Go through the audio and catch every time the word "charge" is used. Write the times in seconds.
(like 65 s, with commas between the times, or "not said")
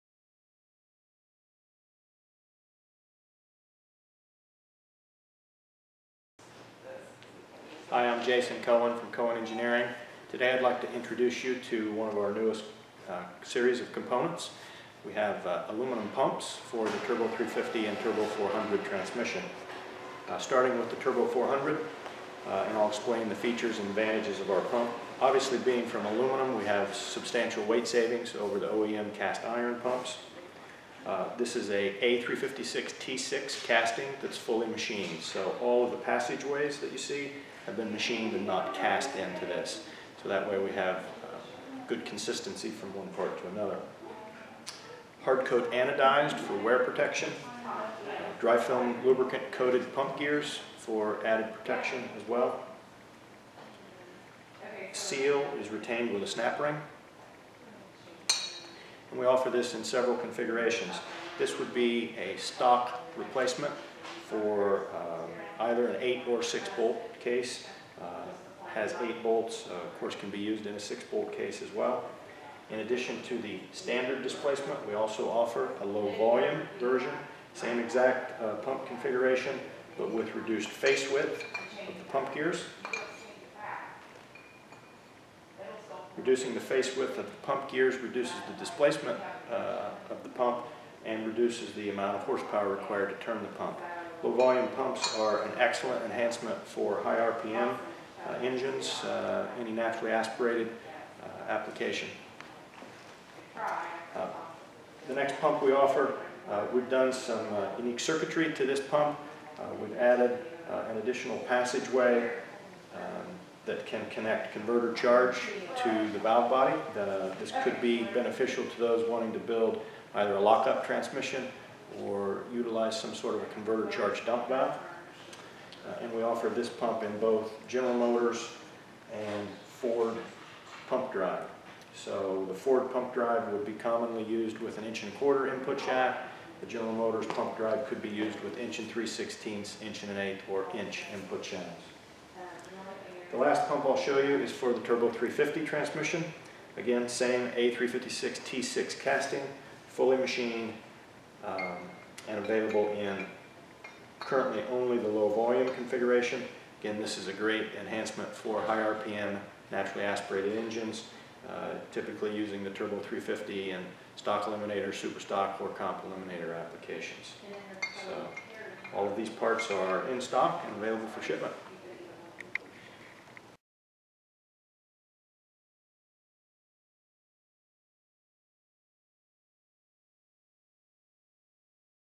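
114 s, 123 s.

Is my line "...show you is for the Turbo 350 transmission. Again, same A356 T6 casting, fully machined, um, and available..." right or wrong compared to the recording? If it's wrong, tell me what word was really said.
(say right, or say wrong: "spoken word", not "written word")
right.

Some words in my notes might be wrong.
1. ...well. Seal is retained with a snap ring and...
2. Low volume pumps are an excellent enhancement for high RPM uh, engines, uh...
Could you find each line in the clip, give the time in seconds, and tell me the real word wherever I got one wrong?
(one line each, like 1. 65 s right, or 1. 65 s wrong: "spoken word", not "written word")
1. 52 s right
2. 94 s right.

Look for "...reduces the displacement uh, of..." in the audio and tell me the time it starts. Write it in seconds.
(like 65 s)
87 s.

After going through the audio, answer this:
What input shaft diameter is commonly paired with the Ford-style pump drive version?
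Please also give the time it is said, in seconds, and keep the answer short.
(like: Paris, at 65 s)
1 1/4 inch, at 134 s.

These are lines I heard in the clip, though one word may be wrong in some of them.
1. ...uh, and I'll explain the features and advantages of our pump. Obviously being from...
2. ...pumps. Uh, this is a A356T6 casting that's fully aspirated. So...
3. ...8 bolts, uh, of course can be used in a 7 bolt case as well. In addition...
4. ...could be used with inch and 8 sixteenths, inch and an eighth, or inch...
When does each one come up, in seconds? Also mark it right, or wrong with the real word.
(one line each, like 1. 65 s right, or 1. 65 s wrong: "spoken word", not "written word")
1. 22 s right
2. 29 s wrong: "machined", not "aspirated"
3. 69 s wrong: "6", not "7"
4. 137 s wrong: "3", not "8".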